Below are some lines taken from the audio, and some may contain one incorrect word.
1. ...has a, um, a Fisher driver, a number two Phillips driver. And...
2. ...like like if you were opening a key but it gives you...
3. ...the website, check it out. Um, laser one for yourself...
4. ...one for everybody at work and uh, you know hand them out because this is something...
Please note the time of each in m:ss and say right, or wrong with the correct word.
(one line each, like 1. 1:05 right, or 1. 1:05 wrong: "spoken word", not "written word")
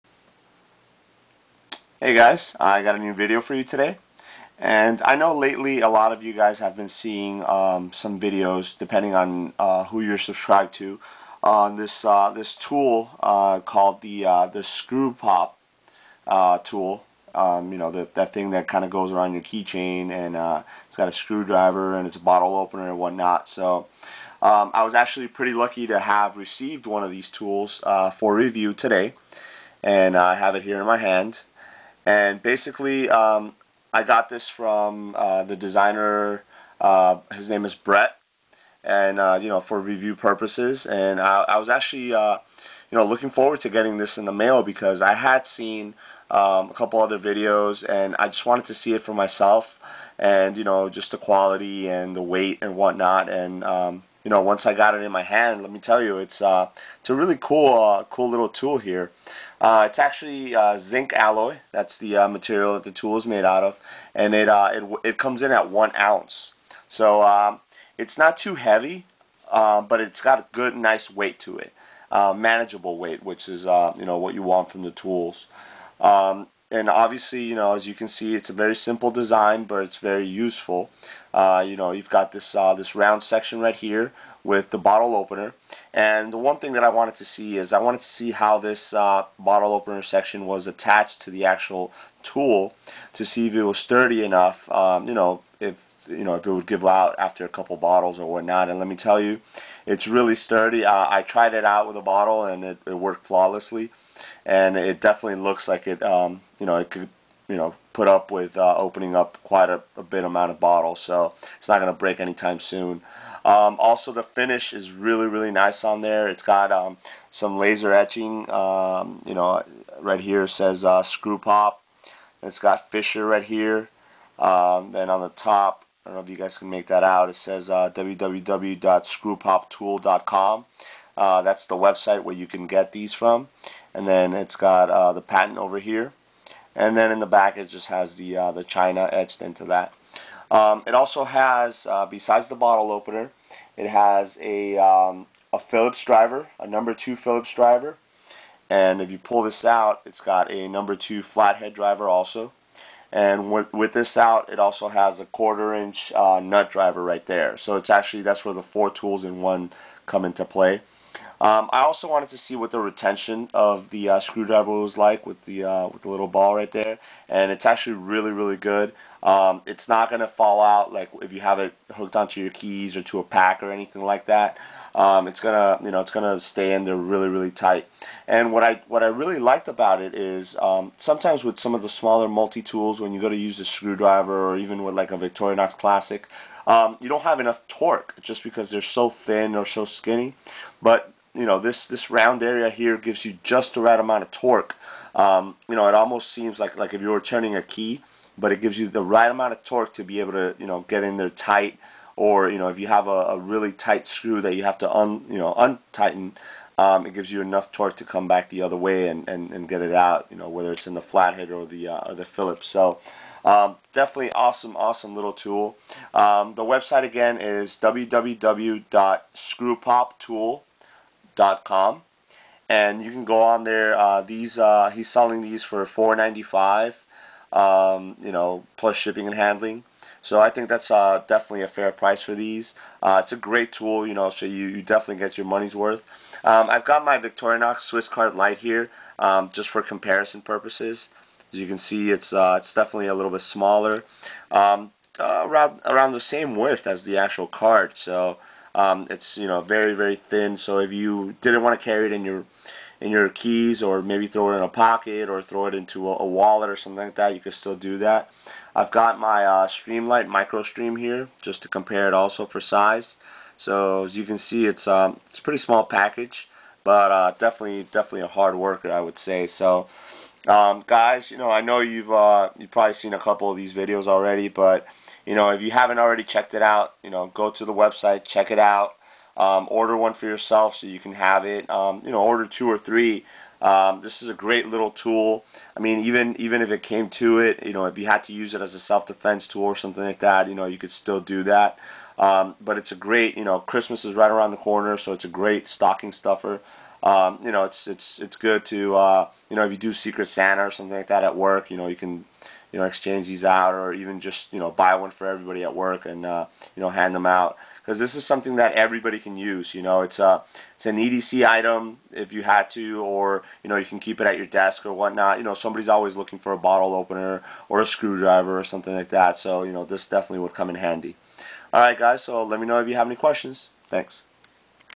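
1. 2:23 wrong: "Phillips", not "Fisher"
2. 3:16 wrong: "turning", not "opening"
3. 4:37 wrong: "order", not "laser"
4. 5:04 right.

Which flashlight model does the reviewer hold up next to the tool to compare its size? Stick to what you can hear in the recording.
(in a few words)
Streamlight Micro Stream.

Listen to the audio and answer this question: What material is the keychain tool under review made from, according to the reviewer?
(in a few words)
Zinc alloy.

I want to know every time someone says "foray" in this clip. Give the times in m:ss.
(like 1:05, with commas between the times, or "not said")
not said.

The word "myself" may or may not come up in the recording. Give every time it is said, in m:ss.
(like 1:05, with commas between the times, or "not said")
0:49.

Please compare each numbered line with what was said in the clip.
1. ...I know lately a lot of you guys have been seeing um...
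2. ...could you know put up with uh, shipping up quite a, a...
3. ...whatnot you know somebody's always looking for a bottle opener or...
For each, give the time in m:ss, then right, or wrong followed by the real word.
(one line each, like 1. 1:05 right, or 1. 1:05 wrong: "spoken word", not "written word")
1. 0:05 right
2. 1:46 wrong: "opening", not "shipping"
3. 5:14 right.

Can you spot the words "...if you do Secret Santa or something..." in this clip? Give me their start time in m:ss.
4:59.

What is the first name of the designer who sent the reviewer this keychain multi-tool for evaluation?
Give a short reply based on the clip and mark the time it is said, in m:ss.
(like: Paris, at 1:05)
Brett, at 0:37.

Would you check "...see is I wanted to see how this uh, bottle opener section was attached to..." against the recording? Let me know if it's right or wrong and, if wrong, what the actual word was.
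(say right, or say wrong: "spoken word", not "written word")
right.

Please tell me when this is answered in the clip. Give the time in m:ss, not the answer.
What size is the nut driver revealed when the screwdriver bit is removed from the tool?
2:35.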